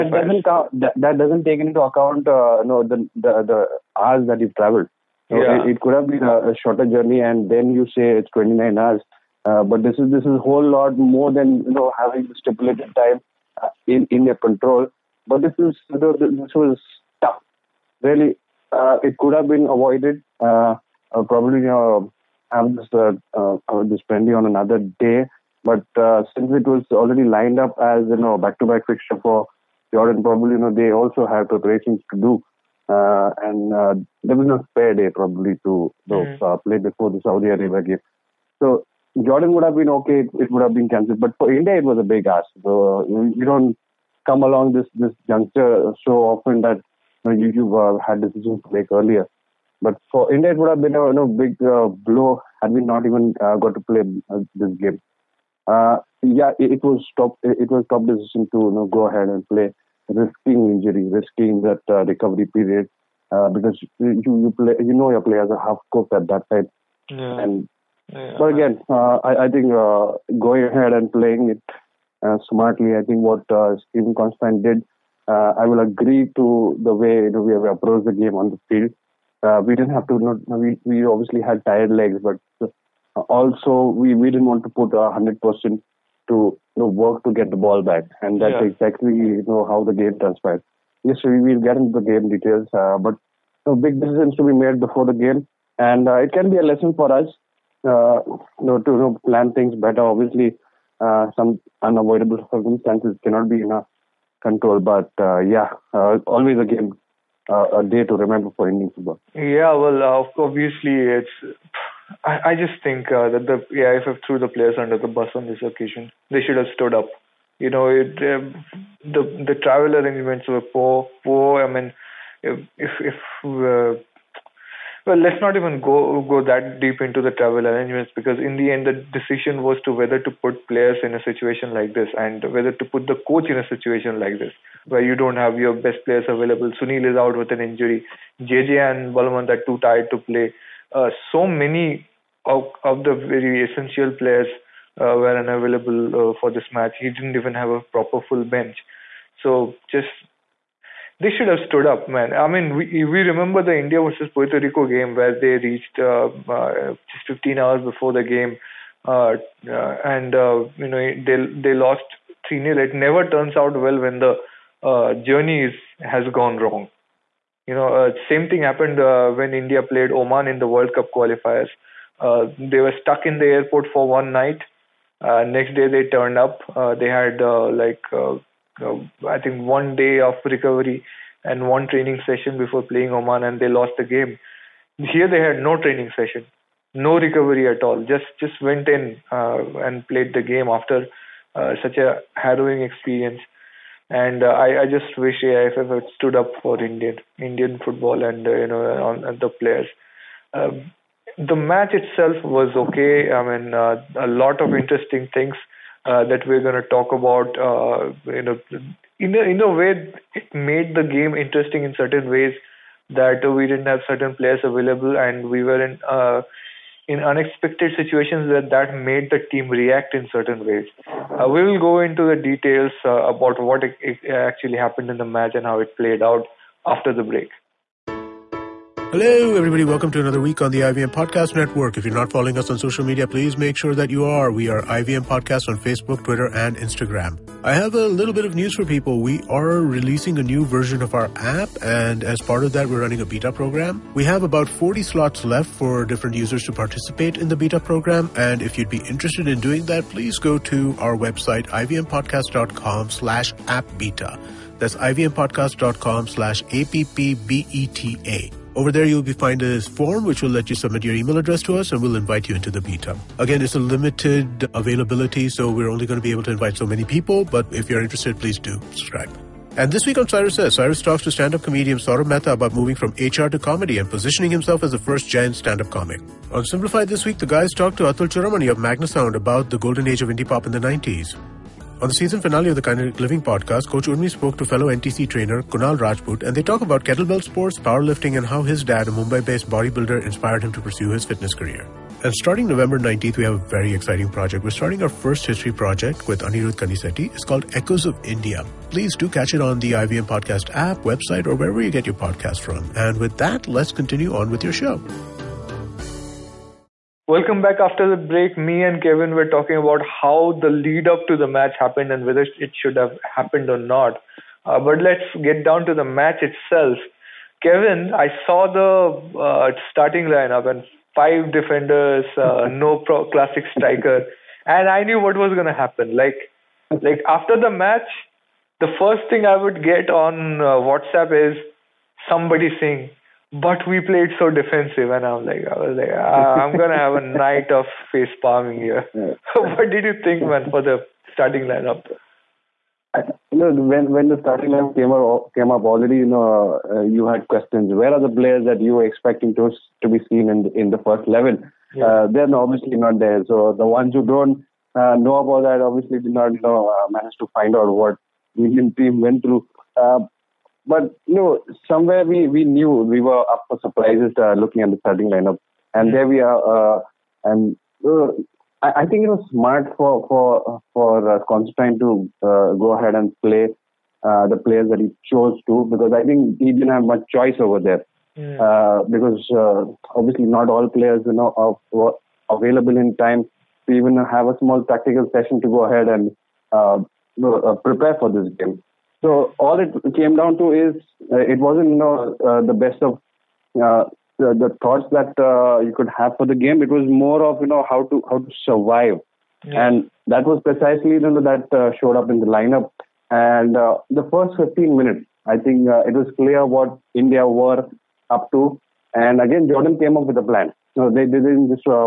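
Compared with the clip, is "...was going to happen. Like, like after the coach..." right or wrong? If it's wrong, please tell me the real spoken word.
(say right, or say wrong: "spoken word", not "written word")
wrong: "match", not "coach".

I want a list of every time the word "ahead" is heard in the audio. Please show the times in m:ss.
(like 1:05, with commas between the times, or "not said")
0:59, 1:10, 6:12, 6:25.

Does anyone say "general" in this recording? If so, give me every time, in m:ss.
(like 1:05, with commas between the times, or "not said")
not said.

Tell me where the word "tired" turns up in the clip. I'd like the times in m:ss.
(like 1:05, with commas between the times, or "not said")
1:21, 2:19.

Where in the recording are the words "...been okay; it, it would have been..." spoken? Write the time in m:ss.
0:39.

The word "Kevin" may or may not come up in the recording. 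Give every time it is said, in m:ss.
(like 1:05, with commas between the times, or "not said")
5:09, 5:17.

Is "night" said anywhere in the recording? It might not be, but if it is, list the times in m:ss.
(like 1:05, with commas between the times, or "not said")
2:54, 5:37.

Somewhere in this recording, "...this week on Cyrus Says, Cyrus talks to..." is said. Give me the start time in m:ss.
4:29.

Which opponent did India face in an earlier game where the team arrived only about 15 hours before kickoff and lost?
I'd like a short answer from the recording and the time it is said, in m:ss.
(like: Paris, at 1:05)
Puerto Rico, at 2:34.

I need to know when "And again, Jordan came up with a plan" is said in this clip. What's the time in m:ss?
6:49.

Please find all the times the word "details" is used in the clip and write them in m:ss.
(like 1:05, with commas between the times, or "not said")
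1:32, 3:42.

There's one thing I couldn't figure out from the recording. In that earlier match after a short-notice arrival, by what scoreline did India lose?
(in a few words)
3-0.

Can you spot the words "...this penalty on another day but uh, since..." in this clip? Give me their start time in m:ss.
0:23.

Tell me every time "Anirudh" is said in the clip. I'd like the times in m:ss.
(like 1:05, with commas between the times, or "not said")
4:56.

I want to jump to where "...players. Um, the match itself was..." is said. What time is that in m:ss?
3:19.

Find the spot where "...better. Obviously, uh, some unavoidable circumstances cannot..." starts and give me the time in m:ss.
1:39.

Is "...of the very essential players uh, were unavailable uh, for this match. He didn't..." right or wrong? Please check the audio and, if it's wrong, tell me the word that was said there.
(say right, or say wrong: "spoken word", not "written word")
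right.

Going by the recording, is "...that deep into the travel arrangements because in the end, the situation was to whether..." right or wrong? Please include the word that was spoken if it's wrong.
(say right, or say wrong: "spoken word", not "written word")
wrong: "decision", not "situation".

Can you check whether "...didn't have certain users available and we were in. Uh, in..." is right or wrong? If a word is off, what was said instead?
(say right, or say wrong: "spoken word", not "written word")
wrong: "players", not "users".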